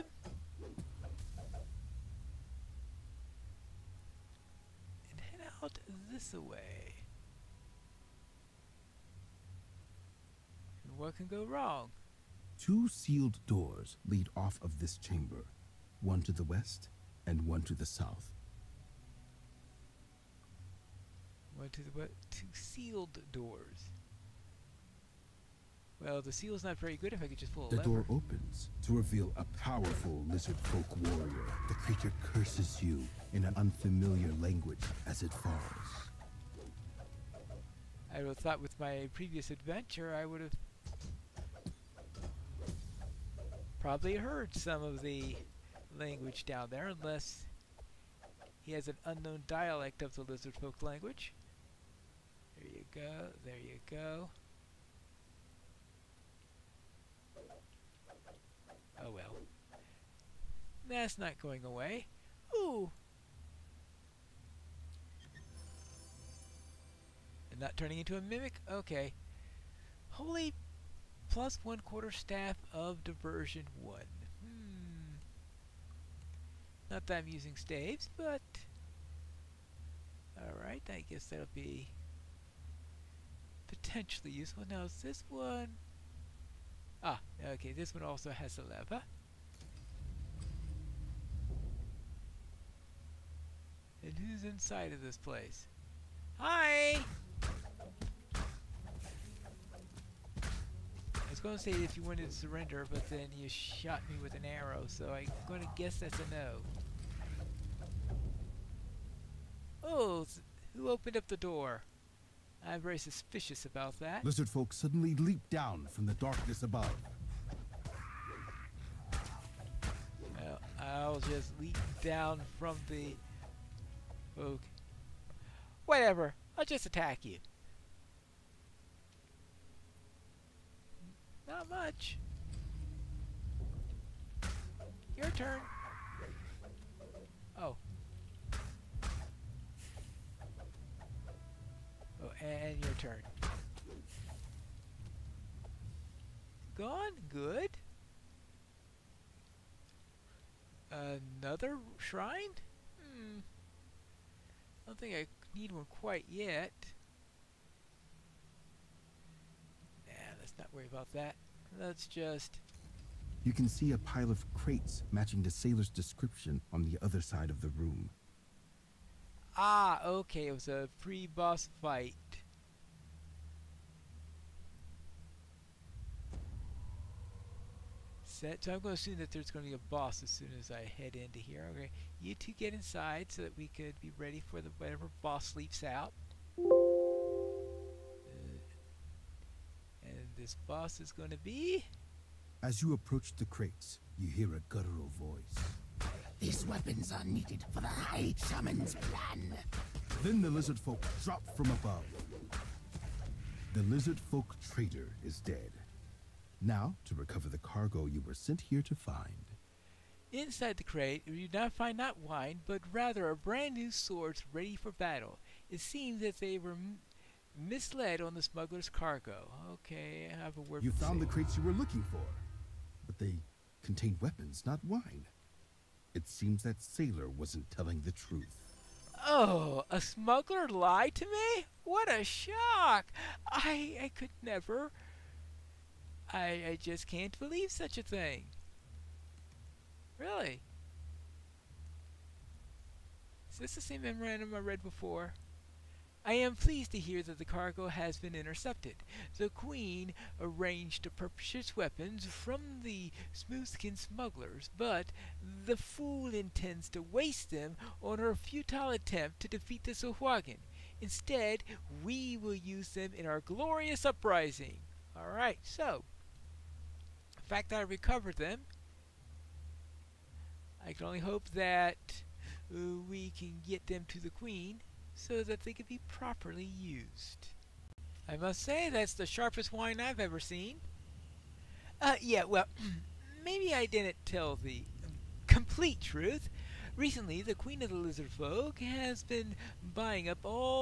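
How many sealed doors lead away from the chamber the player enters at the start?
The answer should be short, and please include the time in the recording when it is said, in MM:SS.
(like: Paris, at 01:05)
2, at 00:12.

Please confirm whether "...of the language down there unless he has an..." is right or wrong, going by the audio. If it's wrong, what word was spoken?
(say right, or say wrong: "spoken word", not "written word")
right.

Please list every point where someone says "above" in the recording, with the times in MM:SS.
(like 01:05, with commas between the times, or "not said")
01:56, 03:21.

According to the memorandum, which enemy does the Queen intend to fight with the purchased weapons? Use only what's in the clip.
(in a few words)
The Sahuagin.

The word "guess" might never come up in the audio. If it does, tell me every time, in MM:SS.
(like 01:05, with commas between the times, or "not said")
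01:21, 01:45.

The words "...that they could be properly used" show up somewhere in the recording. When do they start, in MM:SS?
04:35.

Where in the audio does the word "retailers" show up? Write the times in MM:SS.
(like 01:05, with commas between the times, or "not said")
not said.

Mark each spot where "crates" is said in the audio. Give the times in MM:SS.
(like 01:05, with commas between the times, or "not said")
02:44, 03:13, 03:30, 03:41.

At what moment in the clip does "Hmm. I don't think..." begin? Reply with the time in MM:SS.
02:33.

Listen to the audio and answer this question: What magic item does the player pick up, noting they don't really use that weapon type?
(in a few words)
Plus one quarter staff of diversion.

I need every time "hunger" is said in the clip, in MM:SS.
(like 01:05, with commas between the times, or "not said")
not said.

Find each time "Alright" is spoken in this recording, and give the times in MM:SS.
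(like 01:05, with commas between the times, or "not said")
01:20, 04:25.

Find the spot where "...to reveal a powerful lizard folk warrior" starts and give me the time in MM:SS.
00:28.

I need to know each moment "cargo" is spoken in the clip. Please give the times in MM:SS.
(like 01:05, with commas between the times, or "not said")
03:27, 03:38, 04:07.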